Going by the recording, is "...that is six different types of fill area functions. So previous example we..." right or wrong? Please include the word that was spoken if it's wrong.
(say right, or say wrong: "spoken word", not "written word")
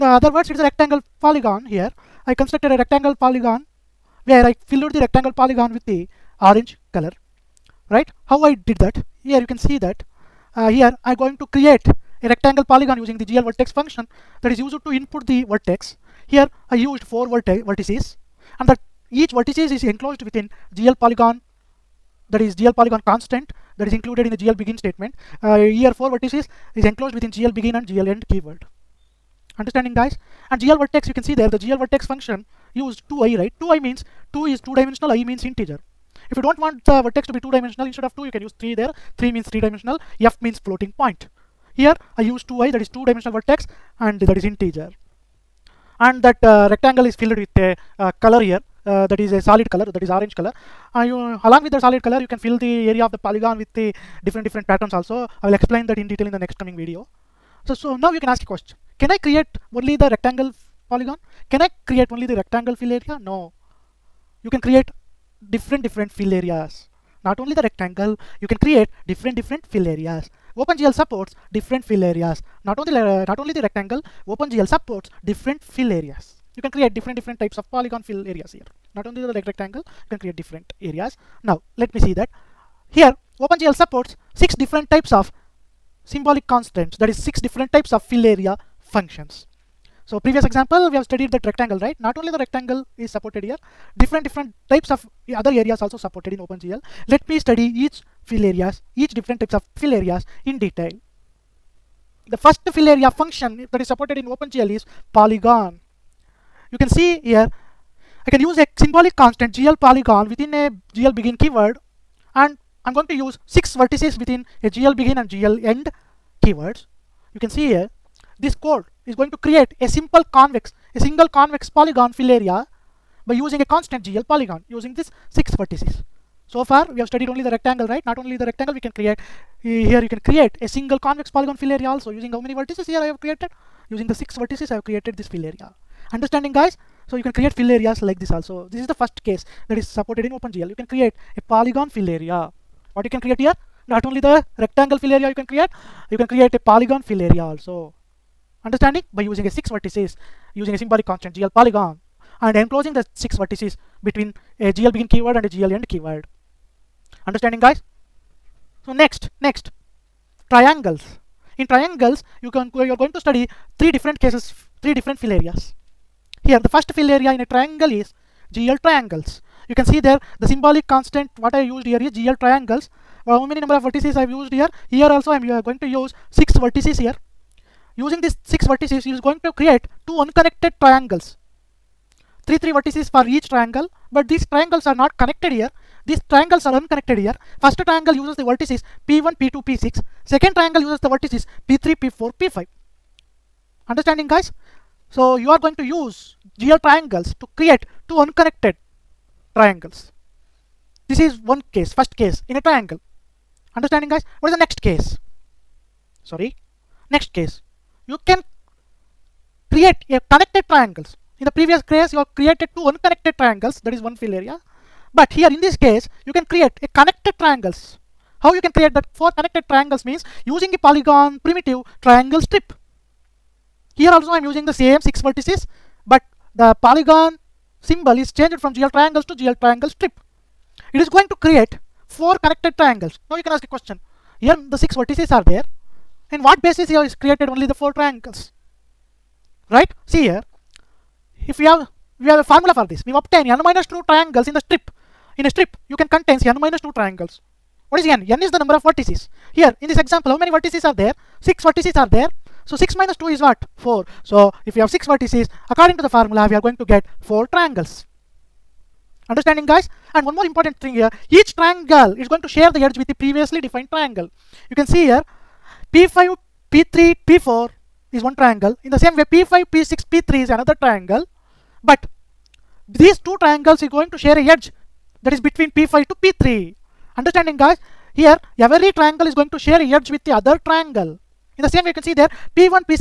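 right.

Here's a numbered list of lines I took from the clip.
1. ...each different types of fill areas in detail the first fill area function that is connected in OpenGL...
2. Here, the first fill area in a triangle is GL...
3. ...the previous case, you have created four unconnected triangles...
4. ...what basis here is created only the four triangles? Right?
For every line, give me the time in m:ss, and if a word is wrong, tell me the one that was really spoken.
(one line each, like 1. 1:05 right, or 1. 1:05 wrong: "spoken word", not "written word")
1. 1:38 wrong: "supported", not "connected"
2. 2:46 right
3. 3:31 wrong: "two", not "four"
4. 3:56 right.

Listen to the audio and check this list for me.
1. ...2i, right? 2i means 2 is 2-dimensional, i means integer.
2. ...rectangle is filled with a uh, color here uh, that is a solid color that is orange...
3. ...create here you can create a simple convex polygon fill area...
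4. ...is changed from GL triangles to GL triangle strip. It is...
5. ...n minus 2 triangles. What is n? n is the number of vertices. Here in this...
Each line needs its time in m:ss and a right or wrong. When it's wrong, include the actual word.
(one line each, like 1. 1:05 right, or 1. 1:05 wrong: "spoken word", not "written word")
1. 0:33 right
2. 0:46 right
3. 2:08 wrong: "single", not "simple"
4. 3:48 right
5. 4:06 right.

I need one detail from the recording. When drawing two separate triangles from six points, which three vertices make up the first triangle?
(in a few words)
P1, P2, P6.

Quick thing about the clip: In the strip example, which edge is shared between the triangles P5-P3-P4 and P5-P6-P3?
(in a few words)
P5 to P3.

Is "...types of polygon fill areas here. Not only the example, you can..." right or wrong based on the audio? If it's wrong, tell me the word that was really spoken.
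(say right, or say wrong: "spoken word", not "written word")
wrong: "rectangle", not "example".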